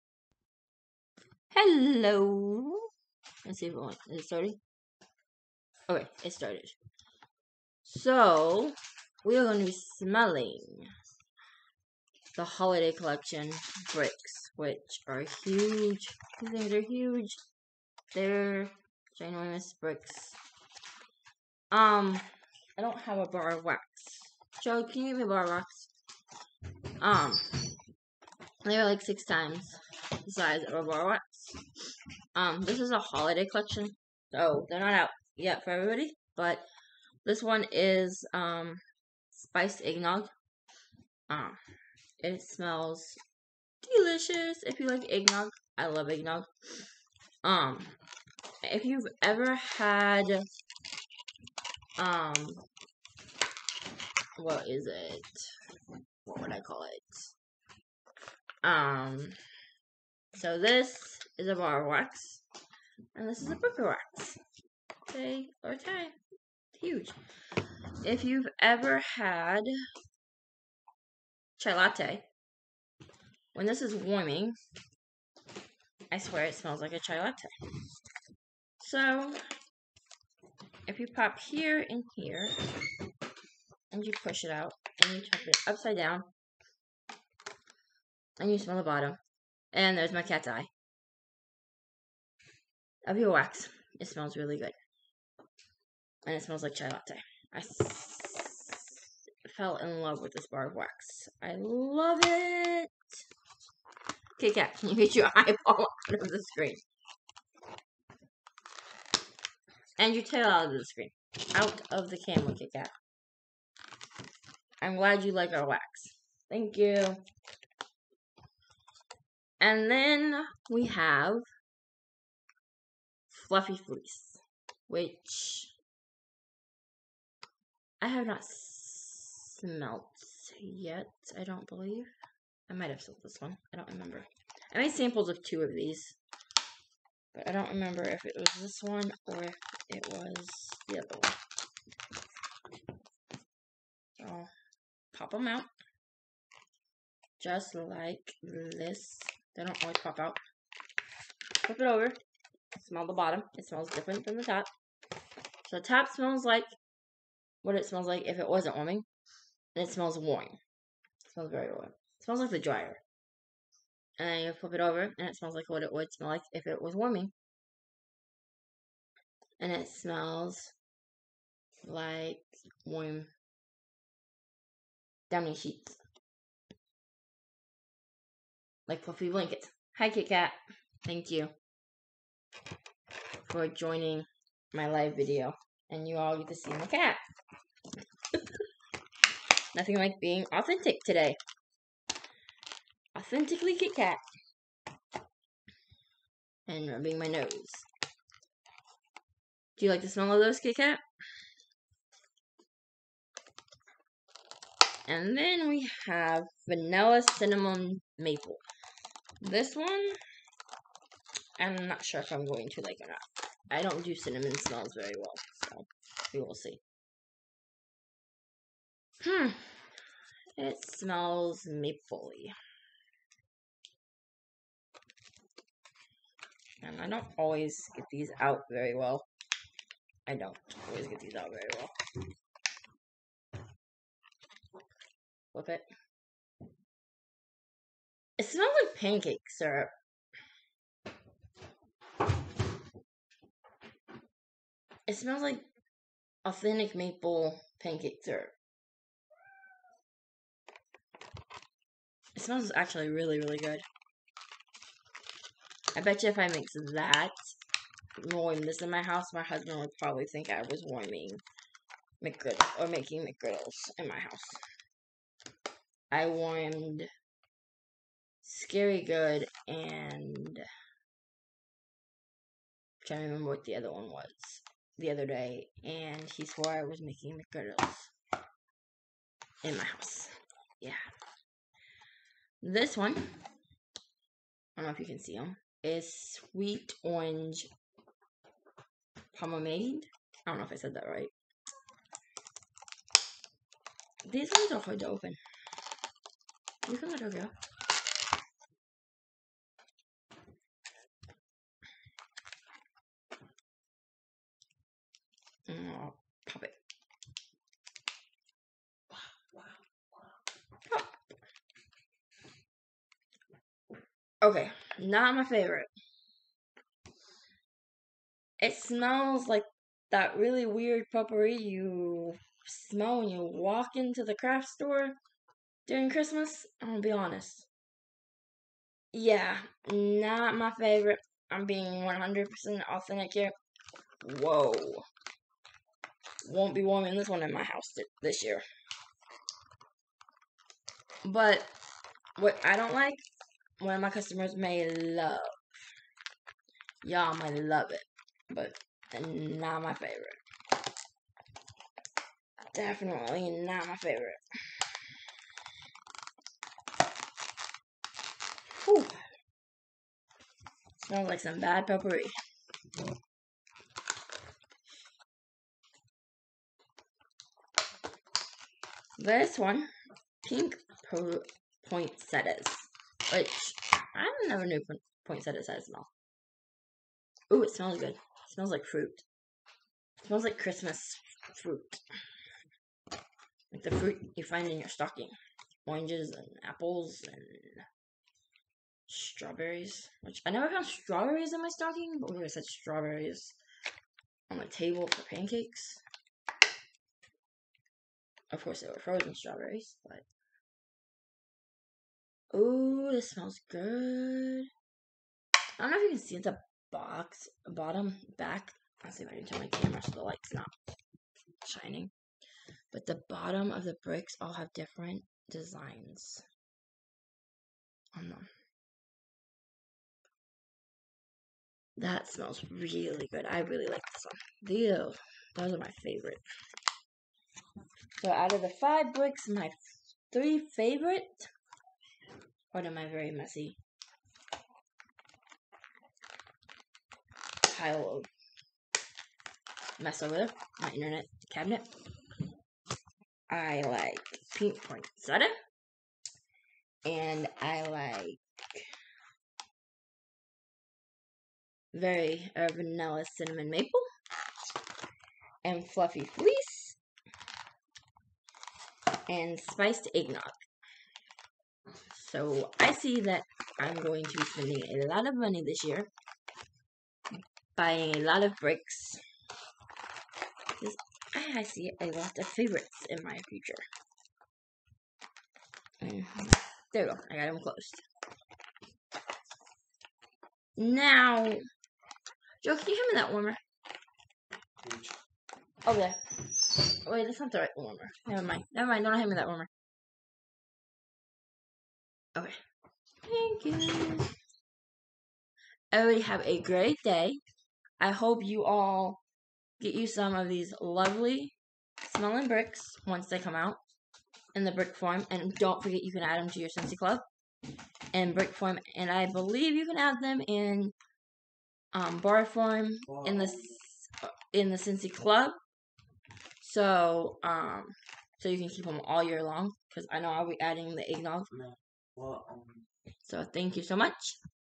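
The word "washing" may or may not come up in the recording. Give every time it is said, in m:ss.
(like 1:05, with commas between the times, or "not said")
not said.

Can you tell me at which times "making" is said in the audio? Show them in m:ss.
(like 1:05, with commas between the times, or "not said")
4:22, 4:37.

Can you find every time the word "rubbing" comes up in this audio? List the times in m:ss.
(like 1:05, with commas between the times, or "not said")
3:16.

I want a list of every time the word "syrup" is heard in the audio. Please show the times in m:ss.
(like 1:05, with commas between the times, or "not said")
3:59, 4:08.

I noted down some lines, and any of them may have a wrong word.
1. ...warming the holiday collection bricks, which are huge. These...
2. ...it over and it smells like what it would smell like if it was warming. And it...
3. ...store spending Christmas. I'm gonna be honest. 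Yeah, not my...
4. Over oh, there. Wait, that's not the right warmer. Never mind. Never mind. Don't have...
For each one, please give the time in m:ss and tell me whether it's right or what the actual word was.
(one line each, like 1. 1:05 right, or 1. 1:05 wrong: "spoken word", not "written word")
1. 0:09 wrong: "smelling", not "warming"
2. 2:44 right
3. 5:24 wrong: "during", not "spending"
4. 8:05 right.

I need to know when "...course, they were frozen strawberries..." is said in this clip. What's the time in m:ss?
6:38.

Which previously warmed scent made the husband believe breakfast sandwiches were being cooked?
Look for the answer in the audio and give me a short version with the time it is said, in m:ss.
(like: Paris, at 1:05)
Scary Good, at 4:28.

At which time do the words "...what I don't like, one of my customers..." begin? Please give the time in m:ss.
5:42.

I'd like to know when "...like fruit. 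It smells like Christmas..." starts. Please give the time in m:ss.
6:18.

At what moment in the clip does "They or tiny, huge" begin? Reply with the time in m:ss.
1:05.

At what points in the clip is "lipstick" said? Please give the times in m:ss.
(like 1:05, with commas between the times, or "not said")
not said.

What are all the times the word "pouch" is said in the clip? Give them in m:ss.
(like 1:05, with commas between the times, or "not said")
not said.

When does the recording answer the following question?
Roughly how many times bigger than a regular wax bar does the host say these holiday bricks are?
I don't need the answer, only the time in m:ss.
0:29.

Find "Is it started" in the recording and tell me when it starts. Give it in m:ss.
0:04.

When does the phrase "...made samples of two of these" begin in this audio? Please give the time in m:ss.
2:14.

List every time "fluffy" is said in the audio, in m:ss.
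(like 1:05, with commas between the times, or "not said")
2:03, 2:59, 7:35.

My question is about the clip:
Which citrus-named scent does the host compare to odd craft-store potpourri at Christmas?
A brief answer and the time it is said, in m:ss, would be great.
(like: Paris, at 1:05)
Sweet Orange Pomade, at 4:46.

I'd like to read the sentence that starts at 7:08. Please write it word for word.
So out of the five books, my three favorite.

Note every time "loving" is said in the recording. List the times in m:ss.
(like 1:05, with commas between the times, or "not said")
not said.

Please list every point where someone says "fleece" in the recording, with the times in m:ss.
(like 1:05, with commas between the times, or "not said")
2:03, 7:36.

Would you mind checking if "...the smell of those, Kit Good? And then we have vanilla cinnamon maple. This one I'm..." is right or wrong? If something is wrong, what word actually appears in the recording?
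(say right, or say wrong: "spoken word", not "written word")
wrong: "Kat", not "Good".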